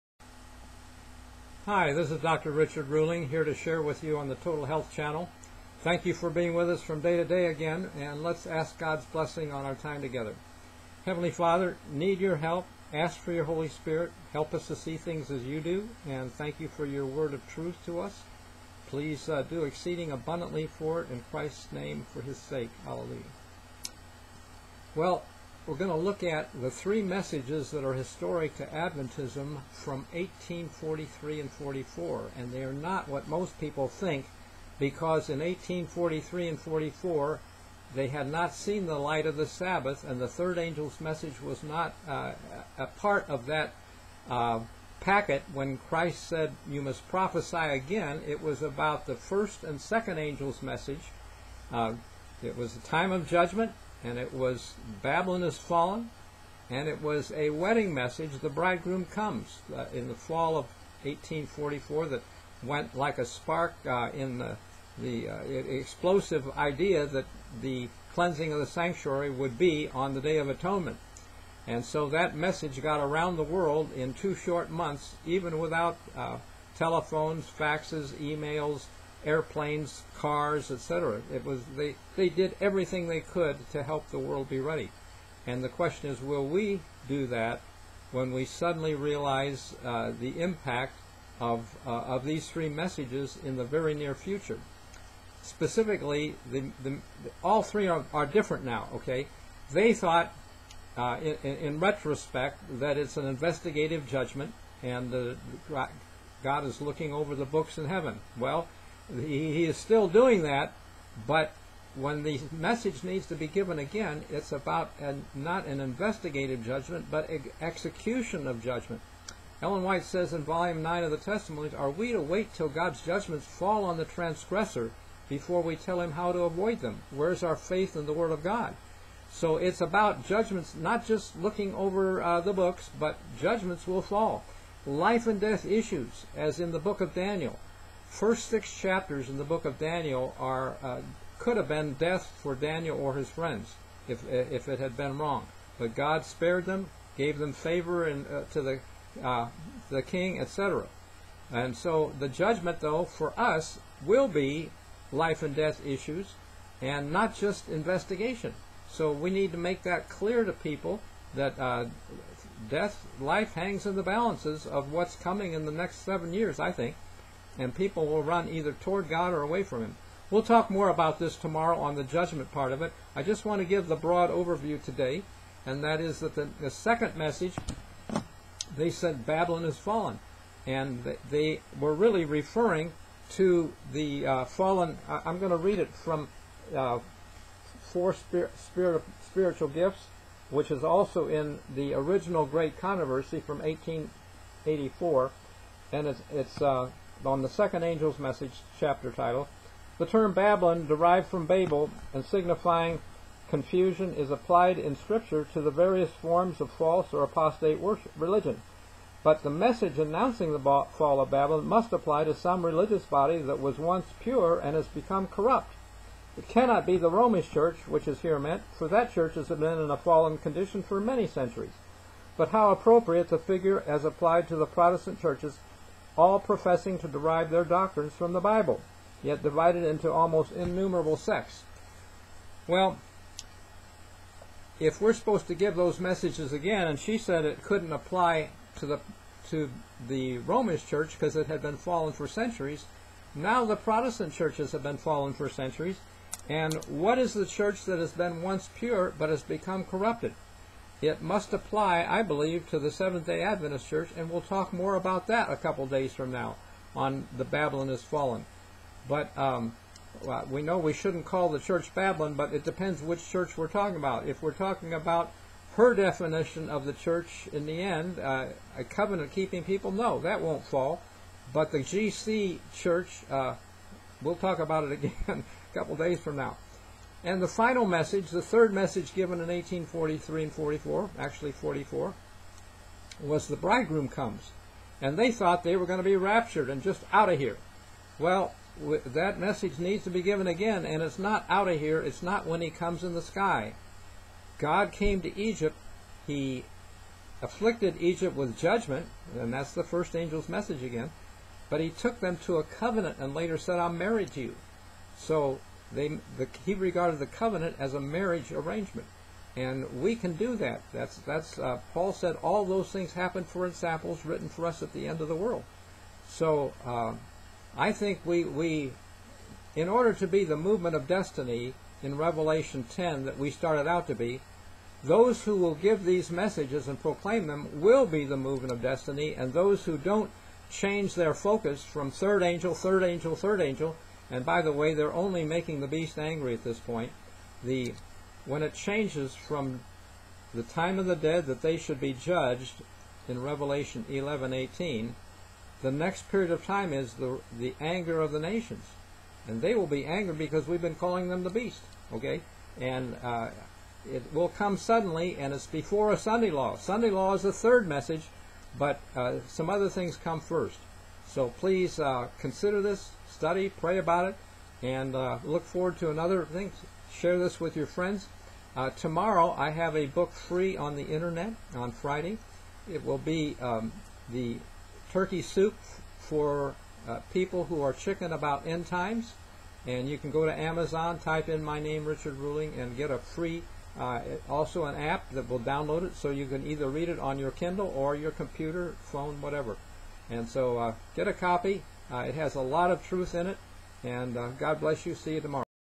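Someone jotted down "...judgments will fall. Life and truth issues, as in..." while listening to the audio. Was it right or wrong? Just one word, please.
wrong.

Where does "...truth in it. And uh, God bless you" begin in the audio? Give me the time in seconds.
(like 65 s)
393 s.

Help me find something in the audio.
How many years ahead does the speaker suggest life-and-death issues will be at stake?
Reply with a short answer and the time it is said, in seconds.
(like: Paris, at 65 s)
7, at 166 s.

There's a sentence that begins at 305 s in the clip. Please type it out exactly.
So they, the, he regarded the covenant as a marriage arrangement.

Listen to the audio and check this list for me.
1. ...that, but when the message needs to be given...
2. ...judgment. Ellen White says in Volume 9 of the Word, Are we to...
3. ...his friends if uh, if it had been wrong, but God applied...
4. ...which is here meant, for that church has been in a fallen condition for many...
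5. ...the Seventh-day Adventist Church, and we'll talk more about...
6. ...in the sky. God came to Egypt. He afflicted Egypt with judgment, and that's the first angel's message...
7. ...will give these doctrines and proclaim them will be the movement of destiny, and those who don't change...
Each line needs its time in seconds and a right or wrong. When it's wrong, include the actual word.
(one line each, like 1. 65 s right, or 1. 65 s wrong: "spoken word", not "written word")
1. 110 s right
2. 118 s wrong: "Testimonies", not "Word"
3. 143 s wrong: "spared", not "applied"
4. 217 s right
5. 252 s right
6. 293 s right
7. 325 s wrong: "messages", not "doctrines".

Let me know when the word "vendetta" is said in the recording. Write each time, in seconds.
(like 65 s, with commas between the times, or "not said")
not said.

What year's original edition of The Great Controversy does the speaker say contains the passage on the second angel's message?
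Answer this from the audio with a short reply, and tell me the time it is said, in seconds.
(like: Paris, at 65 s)
1884, at 193 s.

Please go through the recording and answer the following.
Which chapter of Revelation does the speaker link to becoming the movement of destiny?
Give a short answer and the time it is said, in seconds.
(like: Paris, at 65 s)
Revelation 10, at 322 s.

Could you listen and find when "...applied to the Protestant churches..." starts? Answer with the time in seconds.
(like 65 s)
224 s.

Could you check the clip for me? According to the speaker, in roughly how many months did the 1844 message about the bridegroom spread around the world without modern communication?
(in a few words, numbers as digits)
2.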